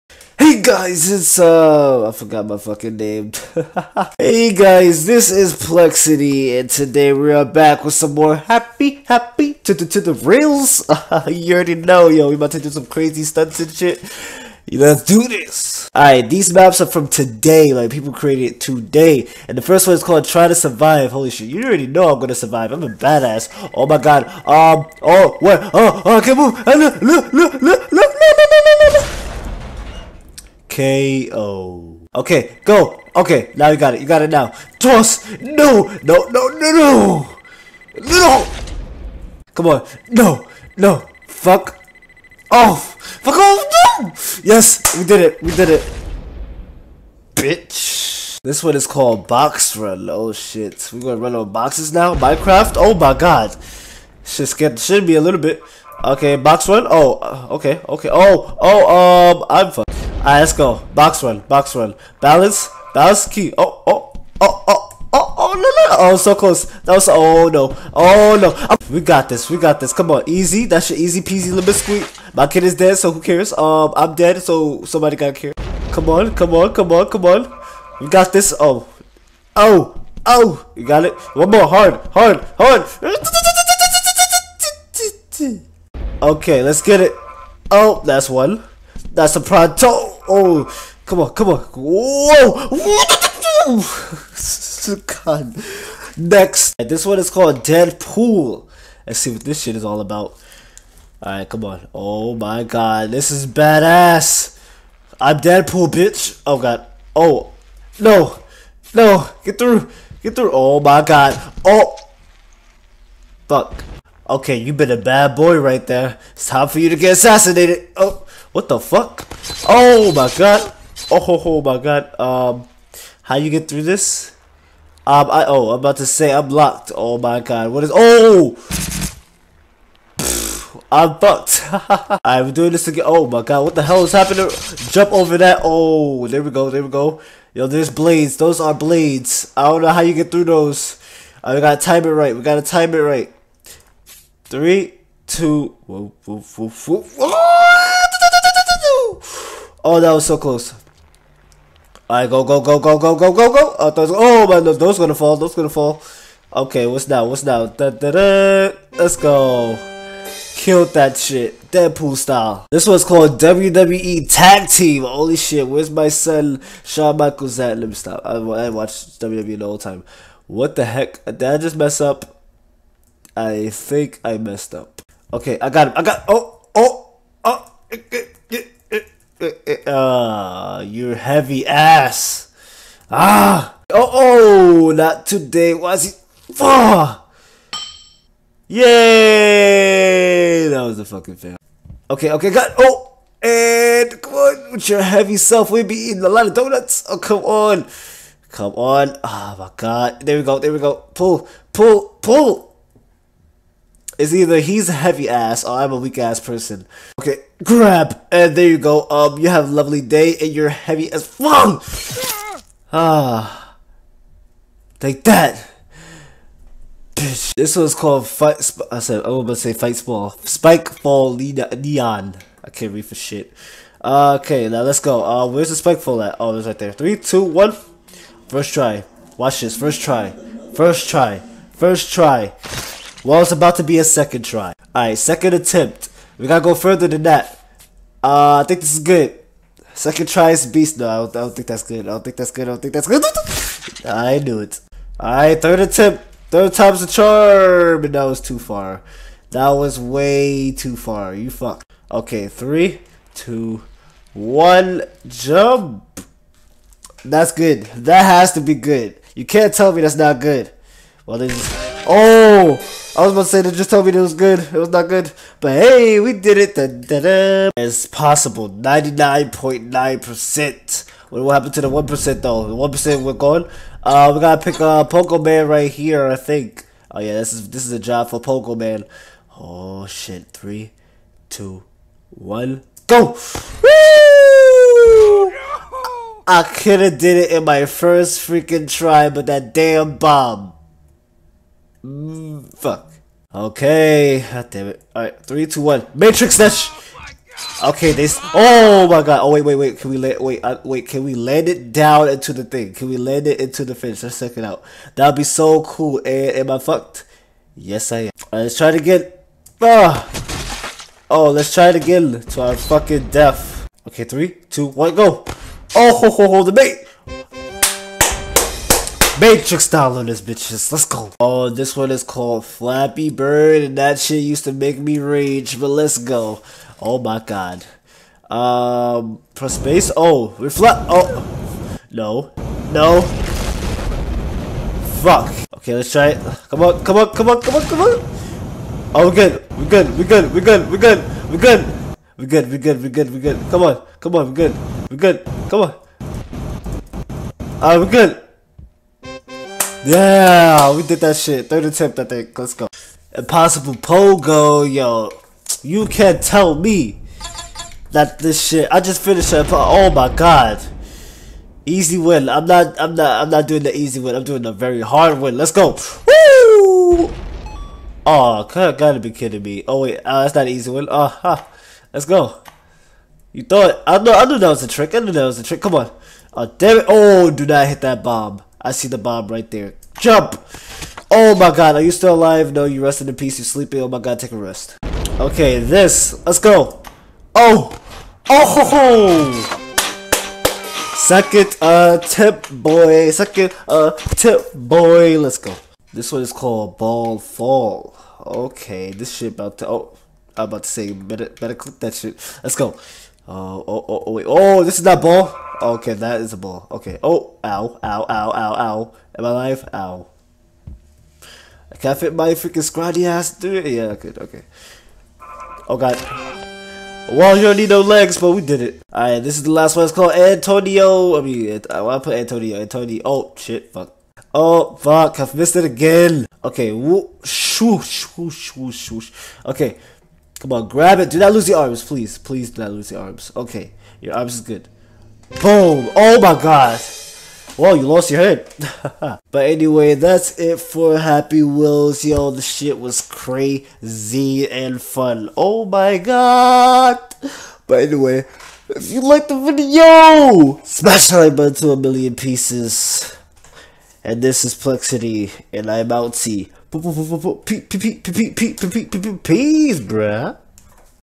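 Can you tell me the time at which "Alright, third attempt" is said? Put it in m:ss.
4:05.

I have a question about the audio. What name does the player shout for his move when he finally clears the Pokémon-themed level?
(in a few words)
Matrix Dash.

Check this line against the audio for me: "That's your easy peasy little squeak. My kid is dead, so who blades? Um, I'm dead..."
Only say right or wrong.
wrong.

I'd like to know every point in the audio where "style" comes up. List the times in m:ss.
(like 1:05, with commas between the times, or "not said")
2:42, 5:19.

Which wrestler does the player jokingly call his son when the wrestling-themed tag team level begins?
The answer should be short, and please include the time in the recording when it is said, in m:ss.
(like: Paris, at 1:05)
Shawn Michaels, at 2:46.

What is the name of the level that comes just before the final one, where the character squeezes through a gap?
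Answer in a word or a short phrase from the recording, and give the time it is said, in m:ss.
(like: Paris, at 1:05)
Ball Fall, at 6:36.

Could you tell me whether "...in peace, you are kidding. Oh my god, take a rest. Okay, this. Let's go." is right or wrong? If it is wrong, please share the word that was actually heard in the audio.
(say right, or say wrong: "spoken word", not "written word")
wrong: "sleeping", not "kidding".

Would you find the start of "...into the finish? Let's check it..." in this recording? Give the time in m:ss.
5:03.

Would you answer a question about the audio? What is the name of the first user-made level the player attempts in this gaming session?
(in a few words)
Try to Survive.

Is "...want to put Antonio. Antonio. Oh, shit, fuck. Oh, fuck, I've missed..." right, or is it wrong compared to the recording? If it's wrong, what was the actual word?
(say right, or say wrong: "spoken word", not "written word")
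right.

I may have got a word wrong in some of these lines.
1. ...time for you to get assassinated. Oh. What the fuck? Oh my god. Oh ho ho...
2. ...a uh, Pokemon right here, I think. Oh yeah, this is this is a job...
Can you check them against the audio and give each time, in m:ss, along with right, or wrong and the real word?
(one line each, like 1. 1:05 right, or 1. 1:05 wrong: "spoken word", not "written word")
1. 1:56 right
2. 4:34 right.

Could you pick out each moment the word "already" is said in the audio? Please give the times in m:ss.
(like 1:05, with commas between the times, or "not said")
0:11, 0:21.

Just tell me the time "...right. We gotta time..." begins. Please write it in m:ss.
2:22.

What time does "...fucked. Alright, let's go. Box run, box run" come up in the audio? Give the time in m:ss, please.
0:59.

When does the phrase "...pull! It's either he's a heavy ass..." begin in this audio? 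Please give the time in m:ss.
3:22.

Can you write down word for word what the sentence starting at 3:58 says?
Uh, I think this is good.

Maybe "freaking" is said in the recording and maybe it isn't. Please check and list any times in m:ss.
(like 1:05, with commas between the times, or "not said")
4:48, 6:52.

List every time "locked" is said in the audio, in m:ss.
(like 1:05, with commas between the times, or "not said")
2:06.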